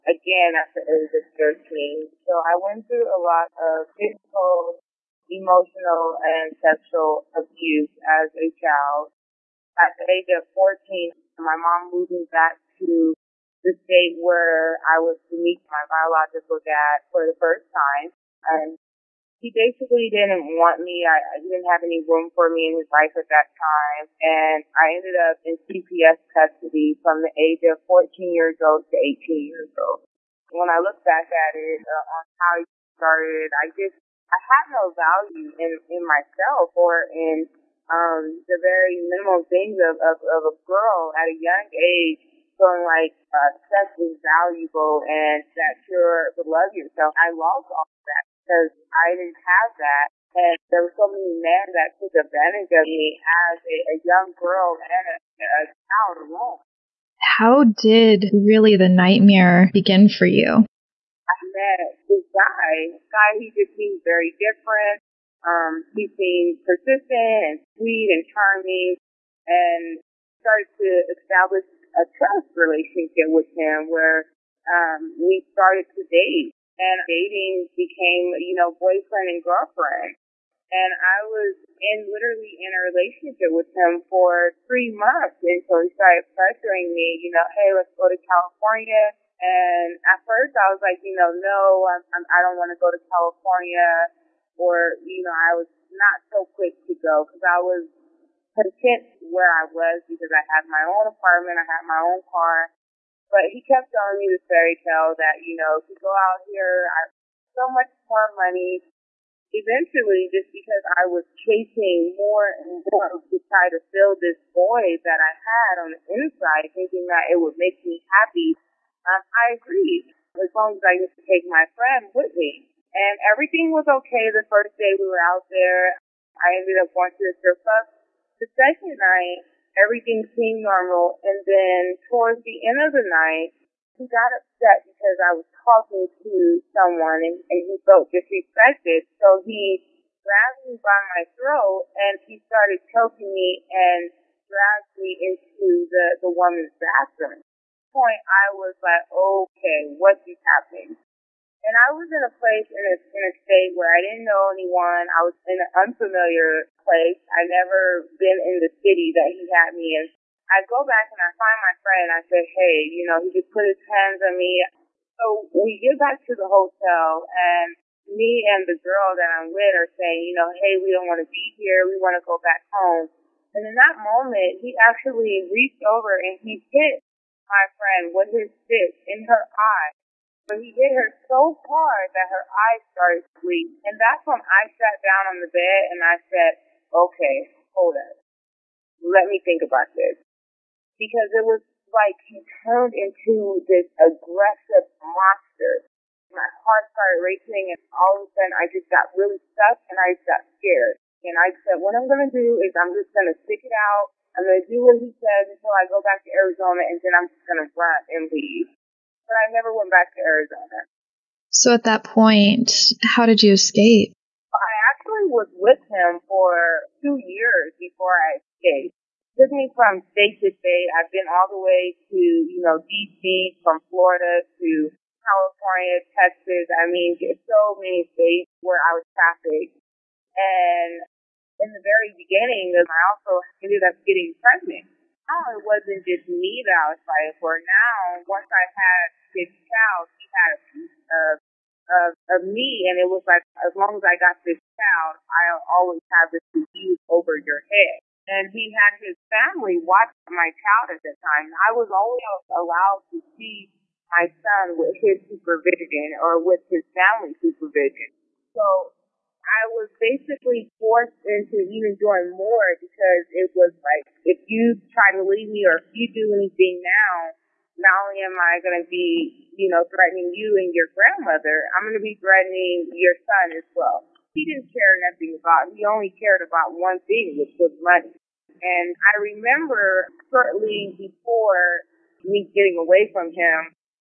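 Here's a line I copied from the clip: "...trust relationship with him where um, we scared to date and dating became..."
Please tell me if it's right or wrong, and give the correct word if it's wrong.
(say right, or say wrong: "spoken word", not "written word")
wrong: "started", not "scared".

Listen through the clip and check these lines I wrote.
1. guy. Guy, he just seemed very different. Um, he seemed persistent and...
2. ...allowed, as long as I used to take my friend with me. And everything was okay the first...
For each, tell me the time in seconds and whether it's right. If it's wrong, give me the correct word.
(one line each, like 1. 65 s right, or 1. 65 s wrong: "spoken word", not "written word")
1. 62 s right
2. 119 s wrong: "agreed", not "allowed".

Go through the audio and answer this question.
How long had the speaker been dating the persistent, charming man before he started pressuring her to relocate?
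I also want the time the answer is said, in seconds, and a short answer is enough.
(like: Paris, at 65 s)
3 months, at 84 s.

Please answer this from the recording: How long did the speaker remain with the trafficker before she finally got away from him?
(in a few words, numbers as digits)
2 years.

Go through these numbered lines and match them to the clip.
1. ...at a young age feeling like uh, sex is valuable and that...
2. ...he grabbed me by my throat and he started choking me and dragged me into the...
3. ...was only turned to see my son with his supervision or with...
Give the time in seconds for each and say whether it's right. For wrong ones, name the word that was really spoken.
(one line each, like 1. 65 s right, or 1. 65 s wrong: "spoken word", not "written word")
1. 41 s right
2. 139 s right
3. 251 s wrong: "allowed", not "turned".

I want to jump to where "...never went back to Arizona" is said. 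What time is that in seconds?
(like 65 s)
209 s.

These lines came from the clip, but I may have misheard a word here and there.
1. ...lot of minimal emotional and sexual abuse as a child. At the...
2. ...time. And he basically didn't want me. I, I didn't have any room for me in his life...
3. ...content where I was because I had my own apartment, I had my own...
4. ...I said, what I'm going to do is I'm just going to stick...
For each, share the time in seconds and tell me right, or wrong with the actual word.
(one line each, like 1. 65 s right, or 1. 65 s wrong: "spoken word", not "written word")
1. 3 s wrong: "physical", not "minimal"
2. 17 s right
3. 98 s right
4. 201 s right.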